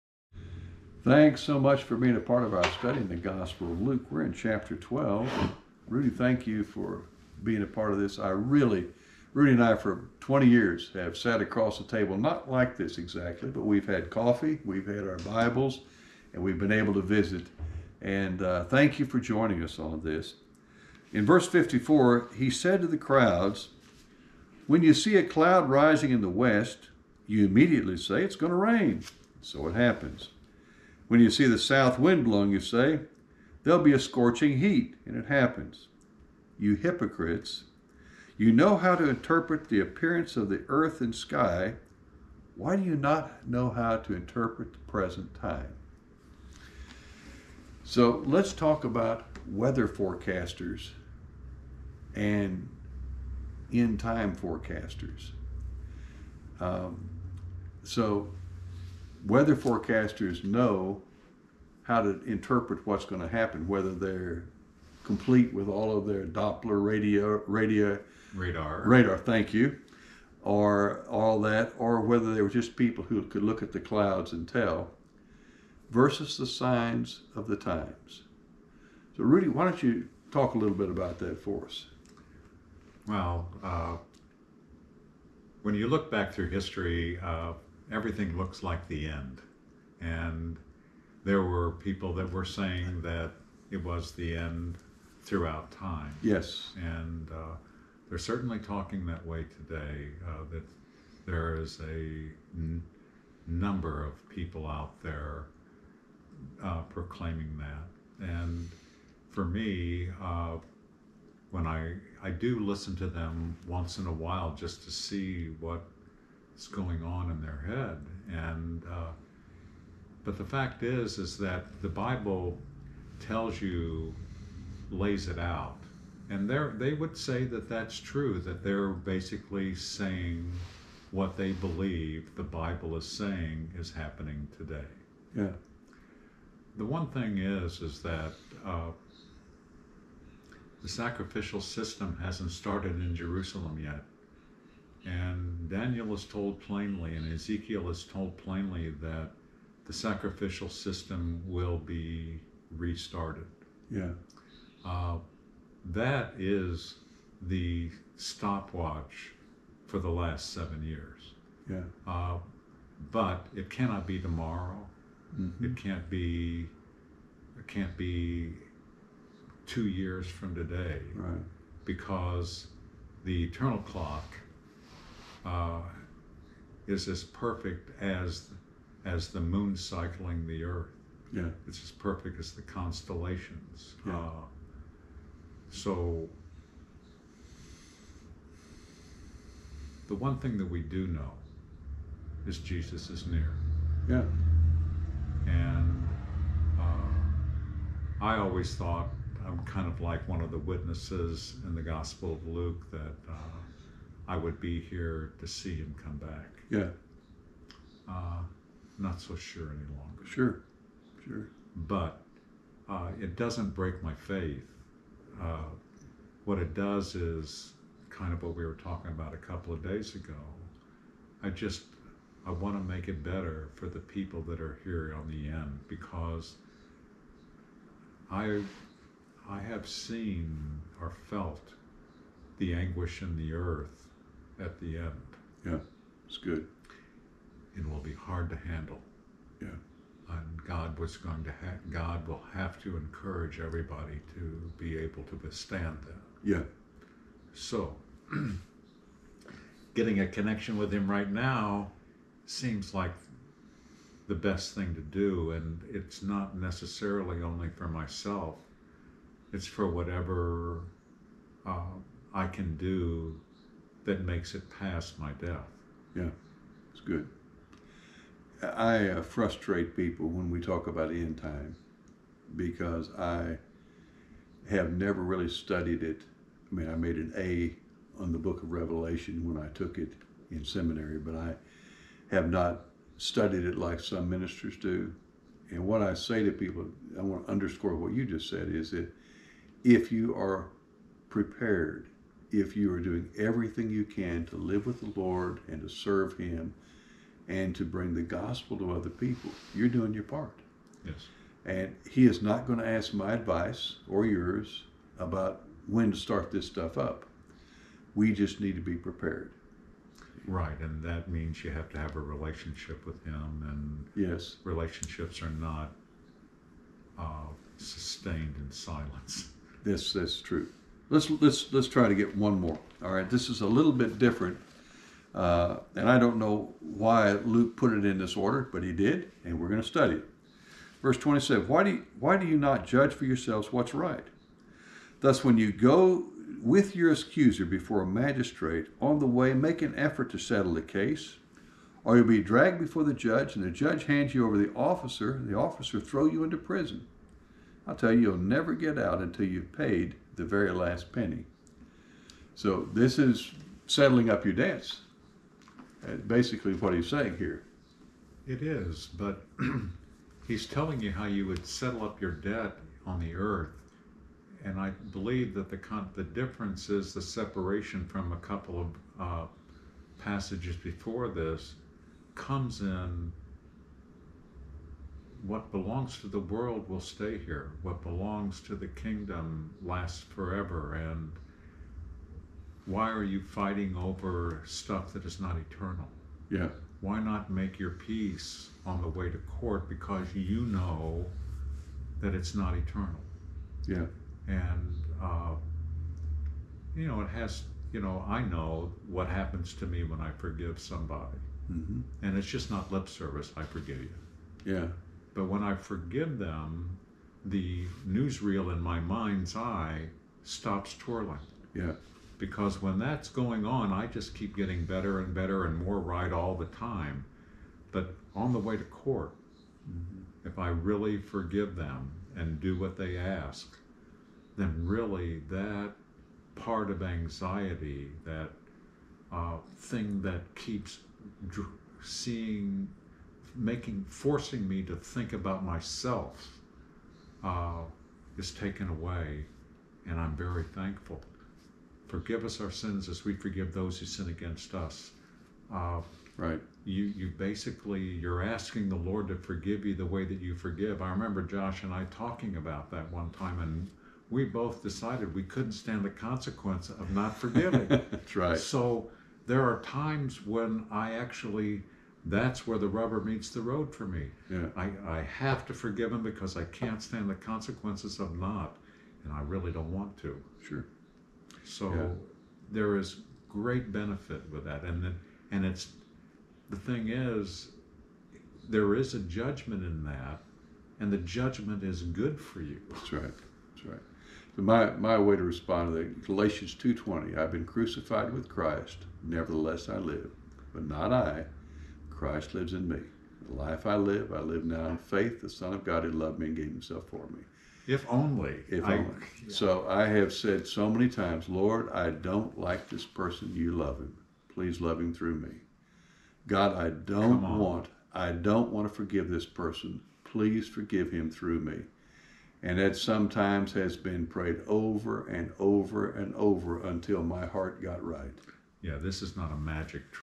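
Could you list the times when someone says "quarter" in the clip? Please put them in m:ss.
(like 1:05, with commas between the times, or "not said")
not said.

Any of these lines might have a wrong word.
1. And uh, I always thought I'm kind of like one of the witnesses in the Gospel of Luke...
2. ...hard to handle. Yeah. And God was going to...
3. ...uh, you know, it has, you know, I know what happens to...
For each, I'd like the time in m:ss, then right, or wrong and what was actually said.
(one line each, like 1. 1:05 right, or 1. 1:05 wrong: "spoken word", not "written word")
1. 3:15 right
2. 3:58 right
3. 6:35 right.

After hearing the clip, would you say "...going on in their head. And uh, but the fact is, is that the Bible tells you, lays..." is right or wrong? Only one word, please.
right.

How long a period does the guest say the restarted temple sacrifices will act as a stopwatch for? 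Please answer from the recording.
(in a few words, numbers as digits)
7 years.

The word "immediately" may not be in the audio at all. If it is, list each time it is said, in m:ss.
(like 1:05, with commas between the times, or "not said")
0:27.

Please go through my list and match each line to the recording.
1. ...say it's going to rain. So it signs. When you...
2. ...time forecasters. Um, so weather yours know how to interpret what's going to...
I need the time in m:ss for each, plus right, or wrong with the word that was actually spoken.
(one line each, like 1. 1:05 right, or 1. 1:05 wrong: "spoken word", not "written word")
1. 0:27 wrong: "happens", not "signs"
2. 0:53 wrong: "forecasters", not "yours".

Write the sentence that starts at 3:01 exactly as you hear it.
Yeah, it's as perfect as the constellations.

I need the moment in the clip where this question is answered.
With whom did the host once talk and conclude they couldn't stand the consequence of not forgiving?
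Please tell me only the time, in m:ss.
7:31.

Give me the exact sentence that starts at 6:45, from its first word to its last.
But when I forgive them, the newsreel in my mind's eye stops twirling.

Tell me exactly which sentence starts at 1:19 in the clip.
So, Rudy, why don't you talk a little bit about that for us?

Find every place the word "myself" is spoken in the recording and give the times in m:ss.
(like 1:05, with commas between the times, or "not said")
4:17, 7:15.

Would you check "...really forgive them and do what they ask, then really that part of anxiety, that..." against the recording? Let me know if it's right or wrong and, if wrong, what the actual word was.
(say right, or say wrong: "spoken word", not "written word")
right.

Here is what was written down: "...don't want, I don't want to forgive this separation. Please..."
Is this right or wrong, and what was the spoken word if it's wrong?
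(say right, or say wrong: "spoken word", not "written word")
wrong: "person", not "separation".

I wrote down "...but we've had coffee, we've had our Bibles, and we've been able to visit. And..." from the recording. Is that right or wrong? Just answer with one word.
right.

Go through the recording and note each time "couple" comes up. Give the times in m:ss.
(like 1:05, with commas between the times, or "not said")
3:39, 6:08.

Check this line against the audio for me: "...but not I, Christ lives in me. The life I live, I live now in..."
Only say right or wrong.
right.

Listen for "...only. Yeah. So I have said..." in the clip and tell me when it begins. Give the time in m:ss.
8:18.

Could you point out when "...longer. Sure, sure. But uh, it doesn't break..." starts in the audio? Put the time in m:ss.
3:29.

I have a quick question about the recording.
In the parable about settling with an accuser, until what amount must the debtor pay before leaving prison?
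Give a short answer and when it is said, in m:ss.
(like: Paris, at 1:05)
The very last penny, at 5:50.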